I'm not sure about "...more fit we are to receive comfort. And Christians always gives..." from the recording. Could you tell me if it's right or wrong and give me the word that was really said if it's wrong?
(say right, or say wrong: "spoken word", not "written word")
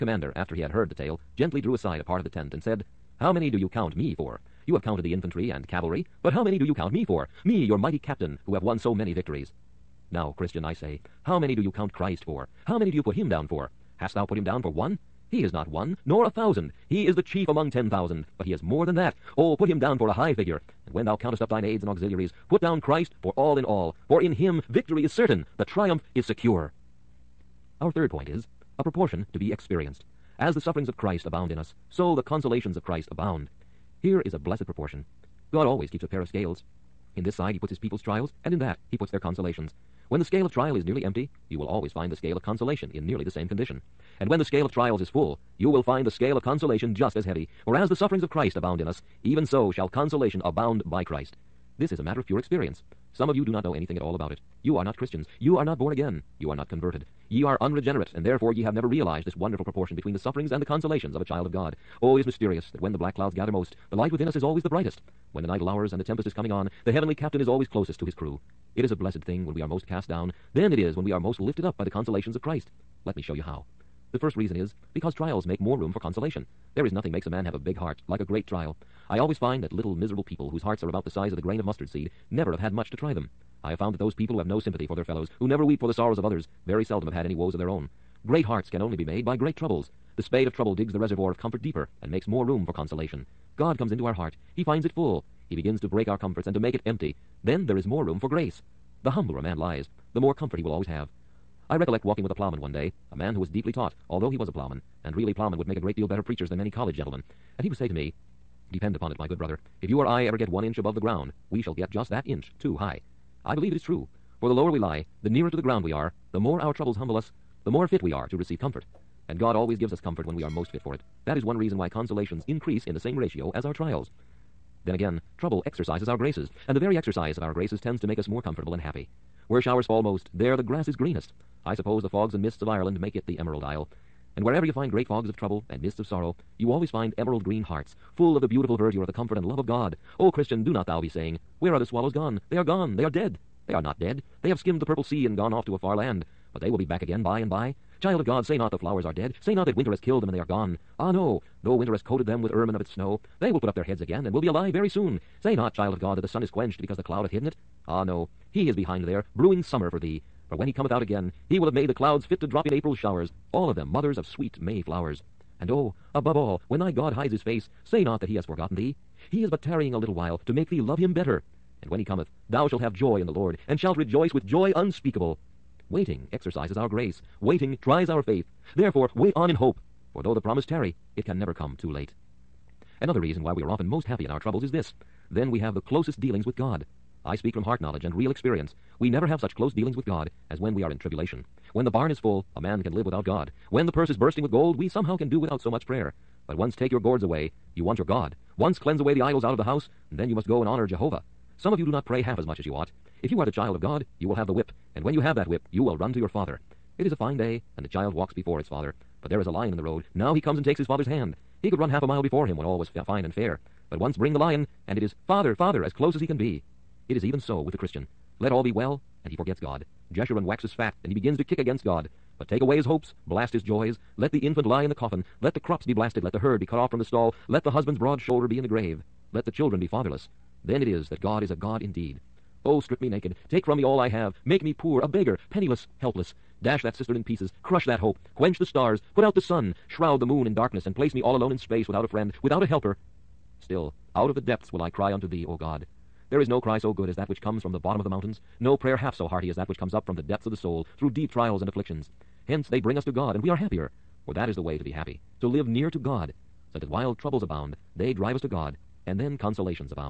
wrong: "God", not "Christians".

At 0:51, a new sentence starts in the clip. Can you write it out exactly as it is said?
This is a matter of pure experience.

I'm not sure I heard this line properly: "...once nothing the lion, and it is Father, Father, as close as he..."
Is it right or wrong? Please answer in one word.
wrong.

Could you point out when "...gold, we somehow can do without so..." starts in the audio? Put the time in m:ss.
3:14.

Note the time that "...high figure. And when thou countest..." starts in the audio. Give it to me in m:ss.
0:20.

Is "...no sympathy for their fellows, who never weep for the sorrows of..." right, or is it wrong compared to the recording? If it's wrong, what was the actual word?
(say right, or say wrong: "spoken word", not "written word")
right.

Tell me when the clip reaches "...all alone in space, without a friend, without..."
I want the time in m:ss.
4:01.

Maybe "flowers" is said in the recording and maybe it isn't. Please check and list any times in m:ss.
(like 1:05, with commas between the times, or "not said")
2:28, 2:44.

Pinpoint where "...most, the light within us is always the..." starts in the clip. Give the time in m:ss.
1:03.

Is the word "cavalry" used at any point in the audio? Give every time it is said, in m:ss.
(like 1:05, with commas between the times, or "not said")
0:05.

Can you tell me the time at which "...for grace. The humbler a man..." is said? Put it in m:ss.
1:38.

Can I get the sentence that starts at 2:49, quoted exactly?
He is but tarrying a little while to make thee love him better.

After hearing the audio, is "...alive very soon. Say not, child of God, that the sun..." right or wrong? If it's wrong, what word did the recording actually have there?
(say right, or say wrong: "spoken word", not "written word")
right.